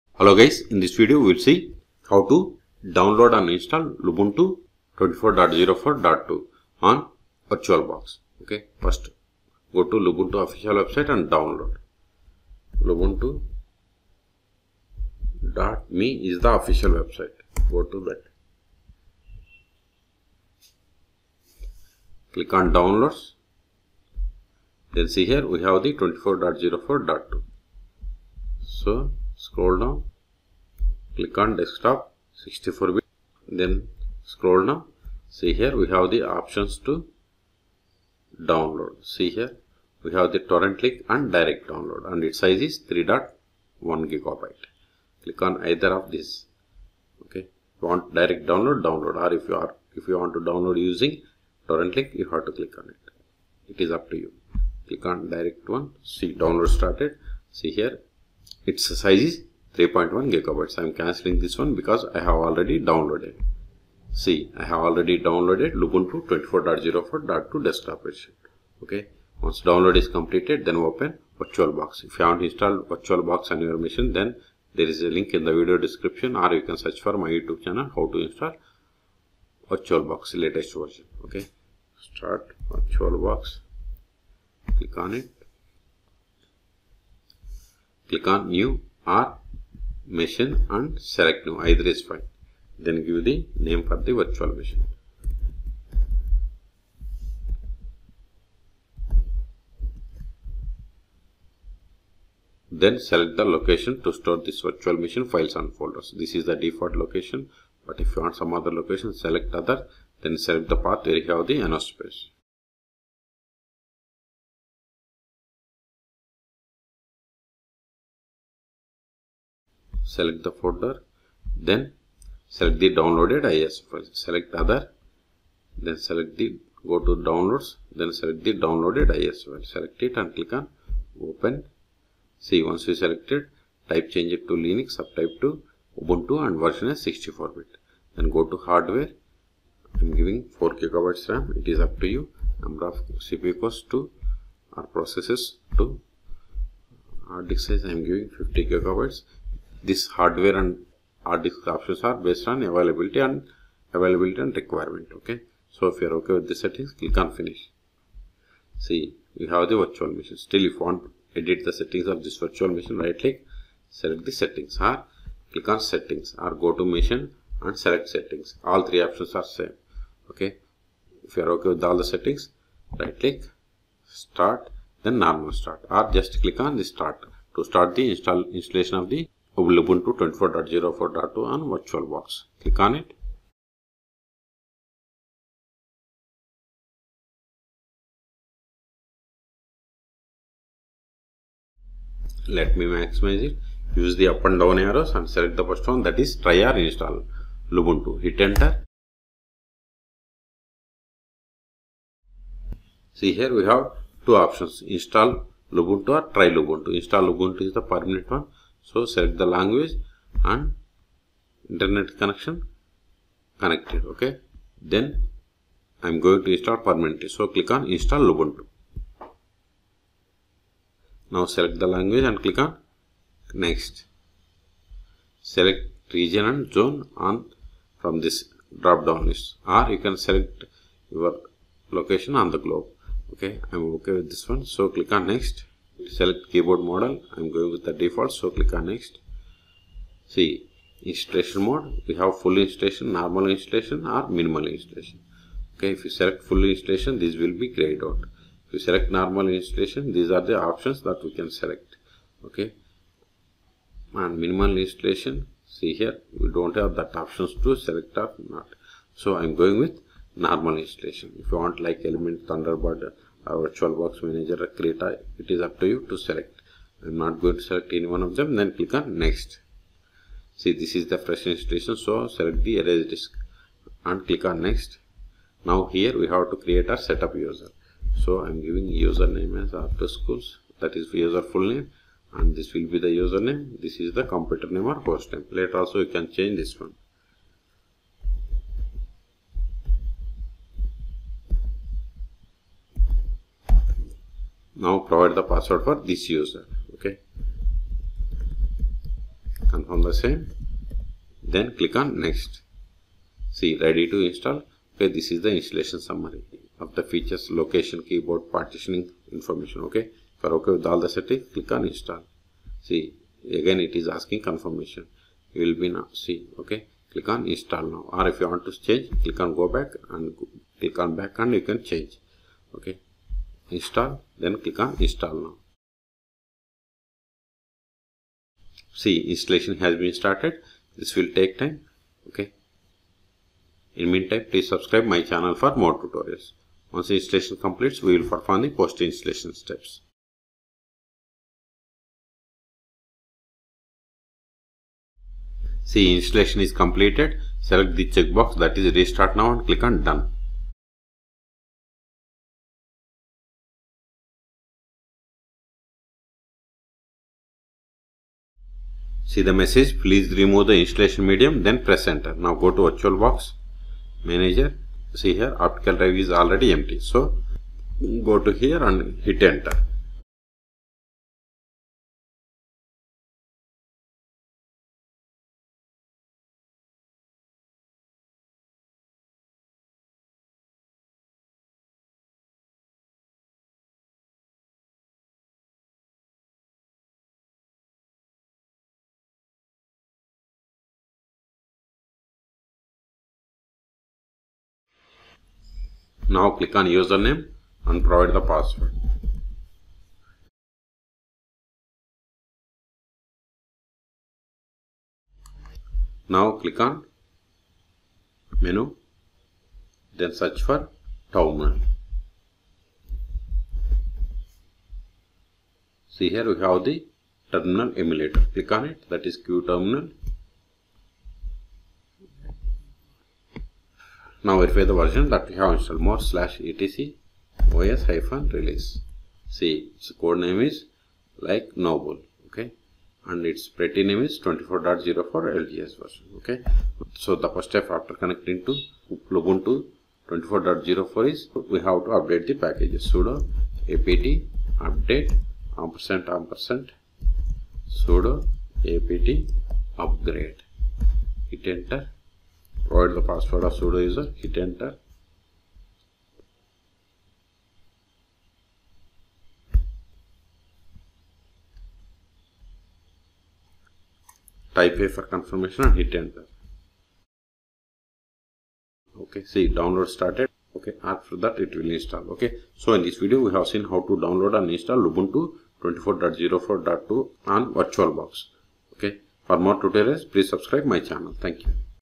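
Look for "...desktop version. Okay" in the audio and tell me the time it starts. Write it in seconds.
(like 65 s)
67 s.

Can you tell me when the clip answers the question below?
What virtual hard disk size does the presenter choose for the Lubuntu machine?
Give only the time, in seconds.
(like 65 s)
148 s.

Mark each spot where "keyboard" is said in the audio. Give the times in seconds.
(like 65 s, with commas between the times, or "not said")
236 s, 308 s.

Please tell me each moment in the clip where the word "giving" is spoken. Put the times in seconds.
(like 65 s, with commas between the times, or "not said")
140 s, 148 s, 278 s.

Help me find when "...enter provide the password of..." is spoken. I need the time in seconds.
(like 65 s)
451 s.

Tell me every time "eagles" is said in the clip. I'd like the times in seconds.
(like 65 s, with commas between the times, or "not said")
not said.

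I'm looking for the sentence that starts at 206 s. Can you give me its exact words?
Install Lubuntu is the permanent one so select the language and internet connection connected.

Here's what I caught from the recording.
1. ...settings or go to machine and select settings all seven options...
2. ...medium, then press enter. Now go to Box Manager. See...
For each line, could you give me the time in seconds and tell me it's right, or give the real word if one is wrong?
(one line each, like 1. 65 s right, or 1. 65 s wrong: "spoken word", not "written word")
1. 165 s wrong: "three", not "seven"
2. 361 s right.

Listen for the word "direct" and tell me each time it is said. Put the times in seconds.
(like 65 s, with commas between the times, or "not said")
41 s, 48 s, 55 s.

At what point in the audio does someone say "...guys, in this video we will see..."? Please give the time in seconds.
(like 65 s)
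0 s.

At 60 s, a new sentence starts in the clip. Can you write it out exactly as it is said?
I'm cancelling this one because I have already downloaded.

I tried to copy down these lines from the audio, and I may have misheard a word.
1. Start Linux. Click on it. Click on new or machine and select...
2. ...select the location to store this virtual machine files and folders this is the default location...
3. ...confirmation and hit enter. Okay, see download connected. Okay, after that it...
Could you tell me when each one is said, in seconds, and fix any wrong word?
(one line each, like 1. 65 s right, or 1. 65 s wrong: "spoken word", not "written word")
1. 81 s wrong: "VirtualBox", not "Linux"
2. 102 s right
3. 465 s wrong: "started", not "connected".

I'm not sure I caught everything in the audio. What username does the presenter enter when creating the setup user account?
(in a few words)
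r2schools.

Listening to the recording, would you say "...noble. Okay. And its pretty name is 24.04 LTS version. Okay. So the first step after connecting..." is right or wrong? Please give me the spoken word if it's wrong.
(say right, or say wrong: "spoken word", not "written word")
right.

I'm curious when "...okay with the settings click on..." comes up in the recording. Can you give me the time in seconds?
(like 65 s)
156 s.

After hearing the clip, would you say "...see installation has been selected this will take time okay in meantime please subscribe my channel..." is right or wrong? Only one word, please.
wrong.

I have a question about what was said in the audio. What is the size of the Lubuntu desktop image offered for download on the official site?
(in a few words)
3.1 GB.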